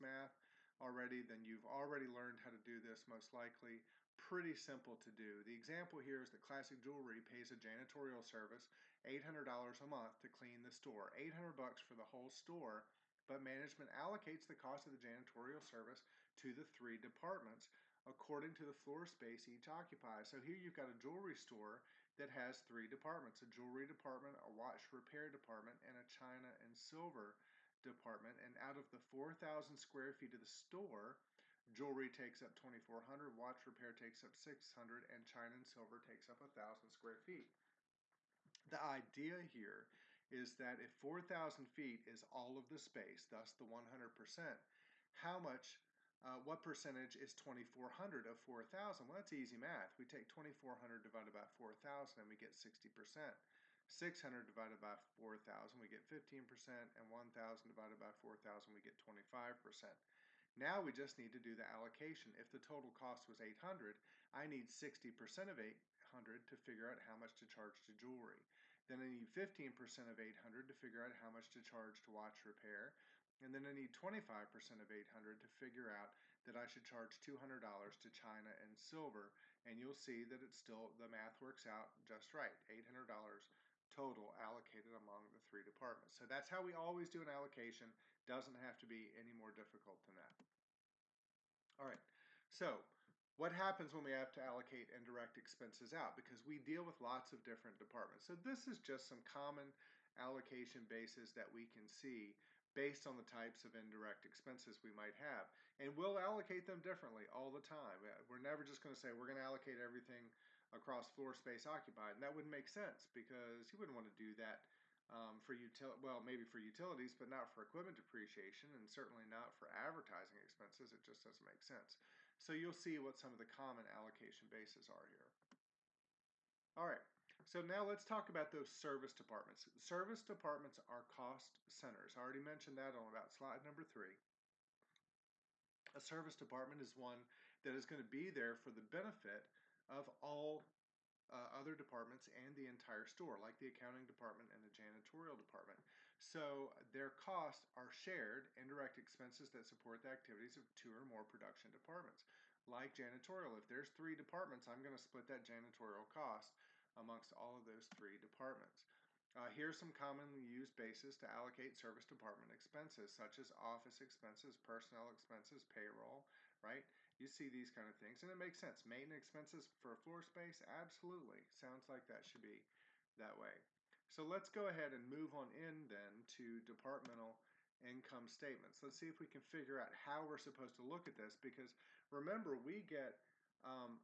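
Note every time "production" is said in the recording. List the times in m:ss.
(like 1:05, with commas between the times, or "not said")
2:31.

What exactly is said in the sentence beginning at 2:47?
You see these kind of things, and it makes sense.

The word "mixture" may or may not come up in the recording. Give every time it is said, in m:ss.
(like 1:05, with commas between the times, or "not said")
not said.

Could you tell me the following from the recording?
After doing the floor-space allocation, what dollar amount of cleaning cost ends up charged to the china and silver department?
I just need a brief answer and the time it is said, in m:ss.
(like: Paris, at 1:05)
$200, at 1:17.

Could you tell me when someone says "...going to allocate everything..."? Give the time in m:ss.
1:49.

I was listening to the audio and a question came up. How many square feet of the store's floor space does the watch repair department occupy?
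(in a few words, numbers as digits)
600.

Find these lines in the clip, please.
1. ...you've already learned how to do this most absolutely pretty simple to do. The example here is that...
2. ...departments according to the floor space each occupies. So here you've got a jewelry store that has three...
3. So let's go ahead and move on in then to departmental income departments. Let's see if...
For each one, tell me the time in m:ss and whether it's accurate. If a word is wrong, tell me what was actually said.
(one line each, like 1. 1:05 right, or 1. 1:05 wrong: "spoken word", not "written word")
1. 0:01 wrong: "likely", not "absolutely"
2. 0:16 right
3. 2:54 wrong: "statements", not "departments".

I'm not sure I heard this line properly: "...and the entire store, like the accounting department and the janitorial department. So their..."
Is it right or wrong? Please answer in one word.
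right.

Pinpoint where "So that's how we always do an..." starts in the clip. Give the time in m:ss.
1:26.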